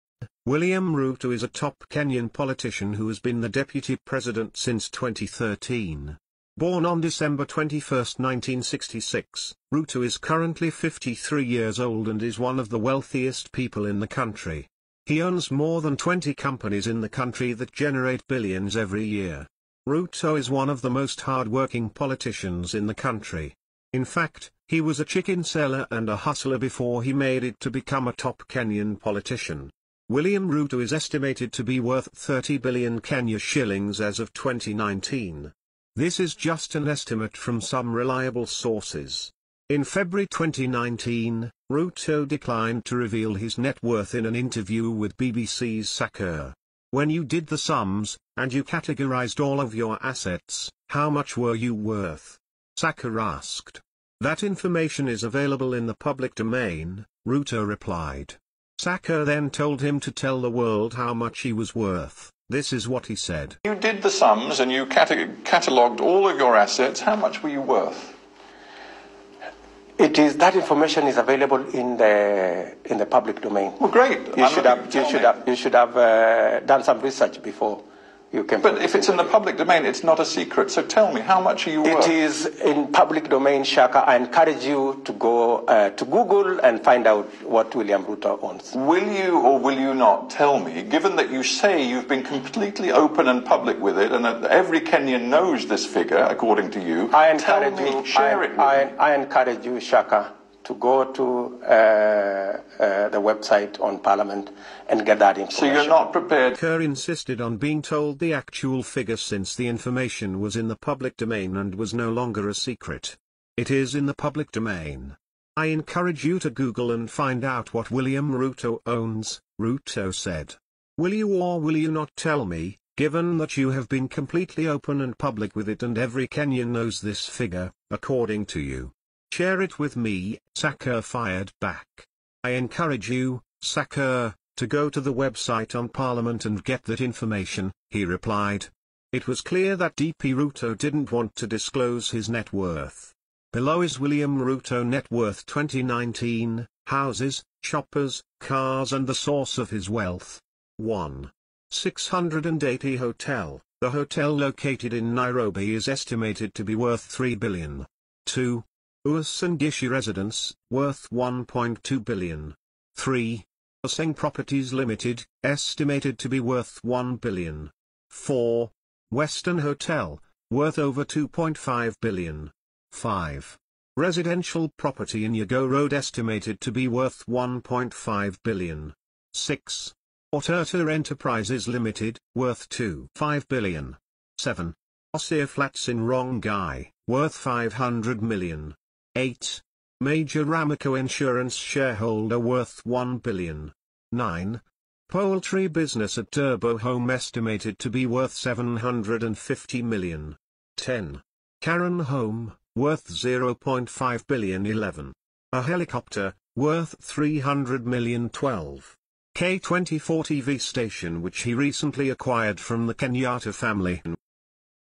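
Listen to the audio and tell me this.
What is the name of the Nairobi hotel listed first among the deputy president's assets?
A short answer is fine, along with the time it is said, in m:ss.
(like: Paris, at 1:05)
680 Hotel, at 2:31.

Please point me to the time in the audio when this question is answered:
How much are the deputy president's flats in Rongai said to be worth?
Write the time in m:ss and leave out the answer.
3:07.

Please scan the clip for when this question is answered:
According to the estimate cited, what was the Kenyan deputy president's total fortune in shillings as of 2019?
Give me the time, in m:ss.
0:32.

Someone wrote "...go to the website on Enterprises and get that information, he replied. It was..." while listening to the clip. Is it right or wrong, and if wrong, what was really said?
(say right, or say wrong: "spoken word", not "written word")
wrong: "Parliament", not "Enterprises".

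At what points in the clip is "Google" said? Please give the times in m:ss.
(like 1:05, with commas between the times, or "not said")
1:26, 1:56.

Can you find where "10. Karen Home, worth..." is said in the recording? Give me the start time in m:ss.
3:20.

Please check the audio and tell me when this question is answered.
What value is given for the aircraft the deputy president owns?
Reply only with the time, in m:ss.
3:27.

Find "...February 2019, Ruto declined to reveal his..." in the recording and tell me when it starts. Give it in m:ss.
0:39.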